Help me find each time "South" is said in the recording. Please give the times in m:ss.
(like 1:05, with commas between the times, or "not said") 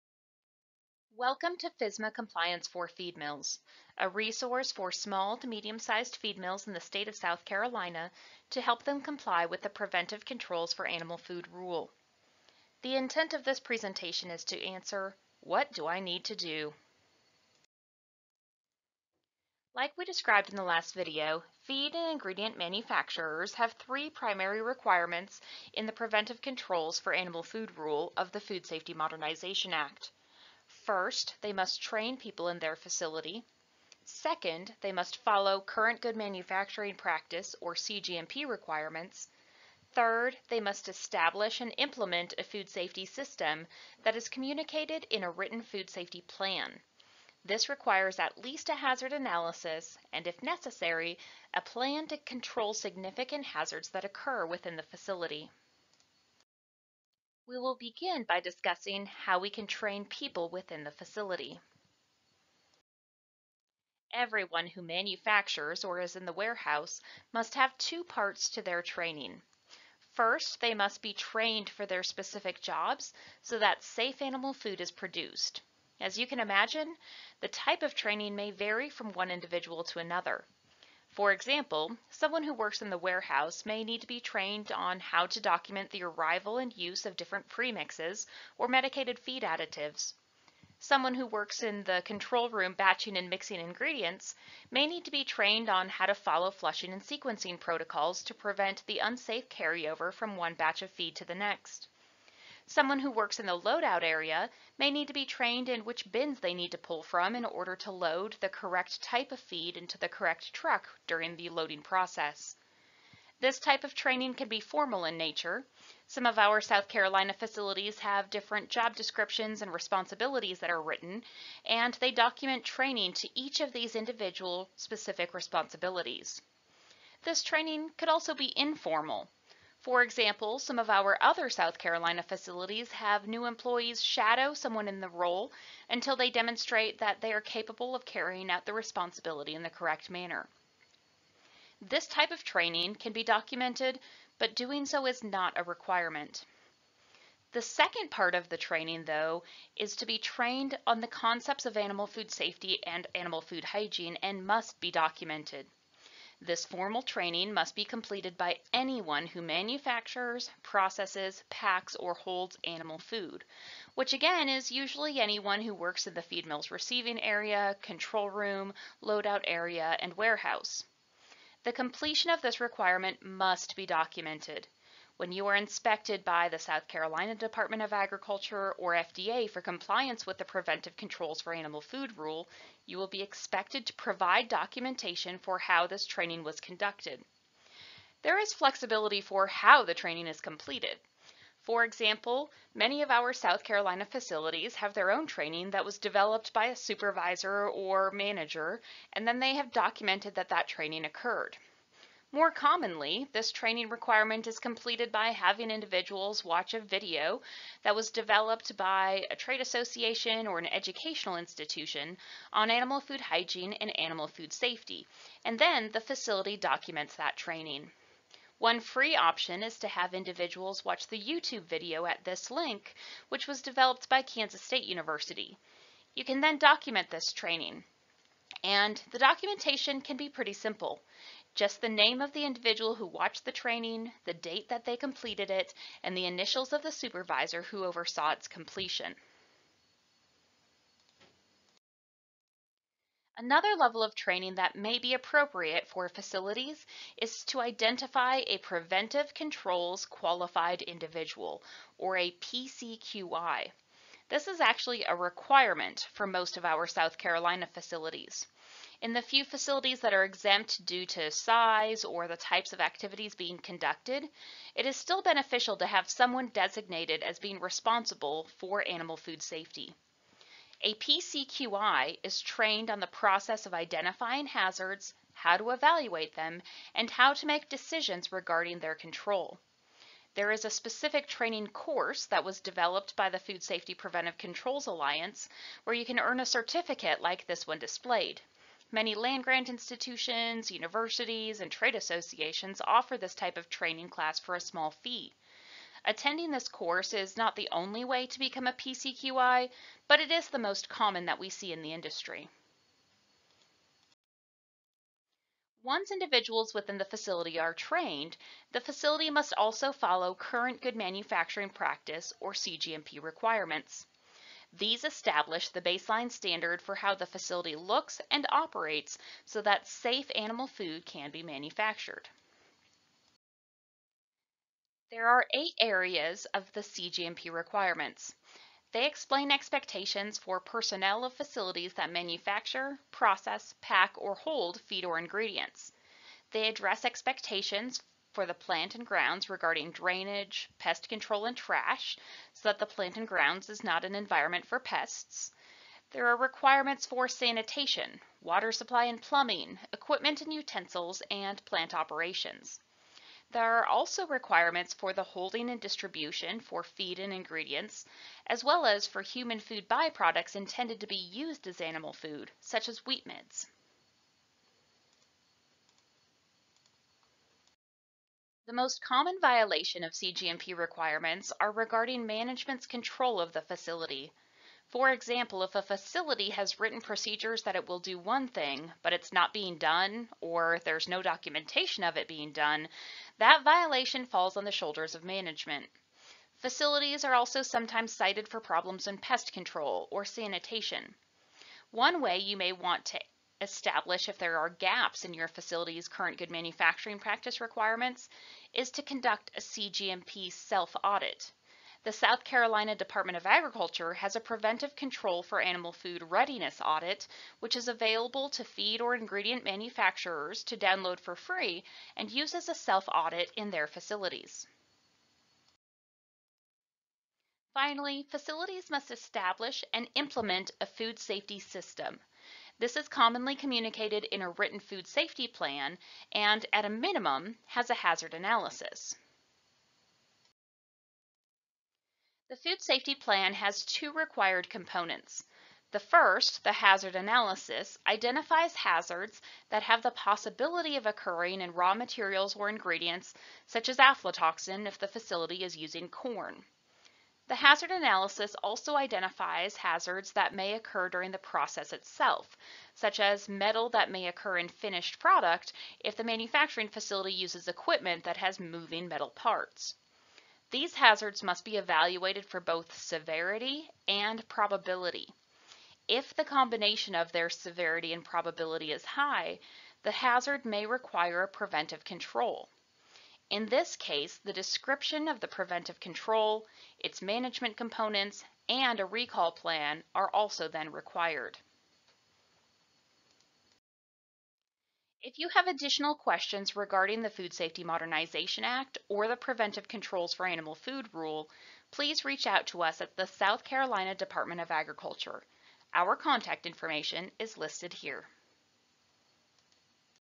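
0:07, 1:56, 2:11, 2:56, 3:13, 4:16, 6:42, 8:13.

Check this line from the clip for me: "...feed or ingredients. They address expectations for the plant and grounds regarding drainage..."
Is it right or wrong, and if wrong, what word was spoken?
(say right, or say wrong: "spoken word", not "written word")
right.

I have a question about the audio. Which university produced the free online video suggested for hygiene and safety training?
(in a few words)
Kansas State University.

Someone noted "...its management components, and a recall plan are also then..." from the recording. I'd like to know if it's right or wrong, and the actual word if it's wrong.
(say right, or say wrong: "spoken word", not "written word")
right.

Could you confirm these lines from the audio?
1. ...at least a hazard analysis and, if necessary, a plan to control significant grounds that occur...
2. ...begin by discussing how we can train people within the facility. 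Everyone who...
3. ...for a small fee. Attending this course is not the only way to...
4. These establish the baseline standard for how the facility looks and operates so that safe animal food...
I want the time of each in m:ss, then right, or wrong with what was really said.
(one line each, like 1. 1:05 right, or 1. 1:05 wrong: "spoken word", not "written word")
1. 0:48 wrong: "hazards", not "grounds"
2. 0:57 right
3. 4:54 right
4. 5:14 right.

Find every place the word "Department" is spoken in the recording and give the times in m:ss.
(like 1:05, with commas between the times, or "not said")
2:57, 6:42, 8:14.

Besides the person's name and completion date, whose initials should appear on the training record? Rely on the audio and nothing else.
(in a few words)
The supervisor's.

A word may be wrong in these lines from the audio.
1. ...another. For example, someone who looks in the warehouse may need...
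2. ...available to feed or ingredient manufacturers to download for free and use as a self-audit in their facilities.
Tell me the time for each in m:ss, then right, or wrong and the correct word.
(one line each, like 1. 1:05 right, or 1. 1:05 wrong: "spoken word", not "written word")
1. 1:19 wrong: "works", not "looks"
2. 6:47 right.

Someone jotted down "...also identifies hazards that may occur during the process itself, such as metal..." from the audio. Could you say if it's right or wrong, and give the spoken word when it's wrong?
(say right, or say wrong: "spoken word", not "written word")
right.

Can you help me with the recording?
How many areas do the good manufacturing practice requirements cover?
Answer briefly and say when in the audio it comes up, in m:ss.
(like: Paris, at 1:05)
8, at 5:25.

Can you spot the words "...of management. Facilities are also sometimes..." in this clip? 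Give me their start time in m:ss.
6:25.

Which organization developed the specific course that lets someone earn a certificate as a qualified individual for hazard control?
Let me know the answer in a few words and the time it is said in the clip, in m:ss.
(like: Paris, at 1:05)
Food Safety Preventive Controls Alliance, at 4:43.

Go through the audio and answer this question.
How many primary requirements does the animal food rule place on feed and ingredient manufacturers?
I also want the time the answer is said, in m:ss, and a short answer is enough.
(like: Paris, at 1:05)
3, at 0:23.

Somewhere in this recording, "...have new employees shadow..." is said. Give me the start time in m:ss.
2:12.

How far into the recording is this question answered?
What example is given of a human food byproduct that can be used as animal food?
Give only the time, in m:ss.
6:03.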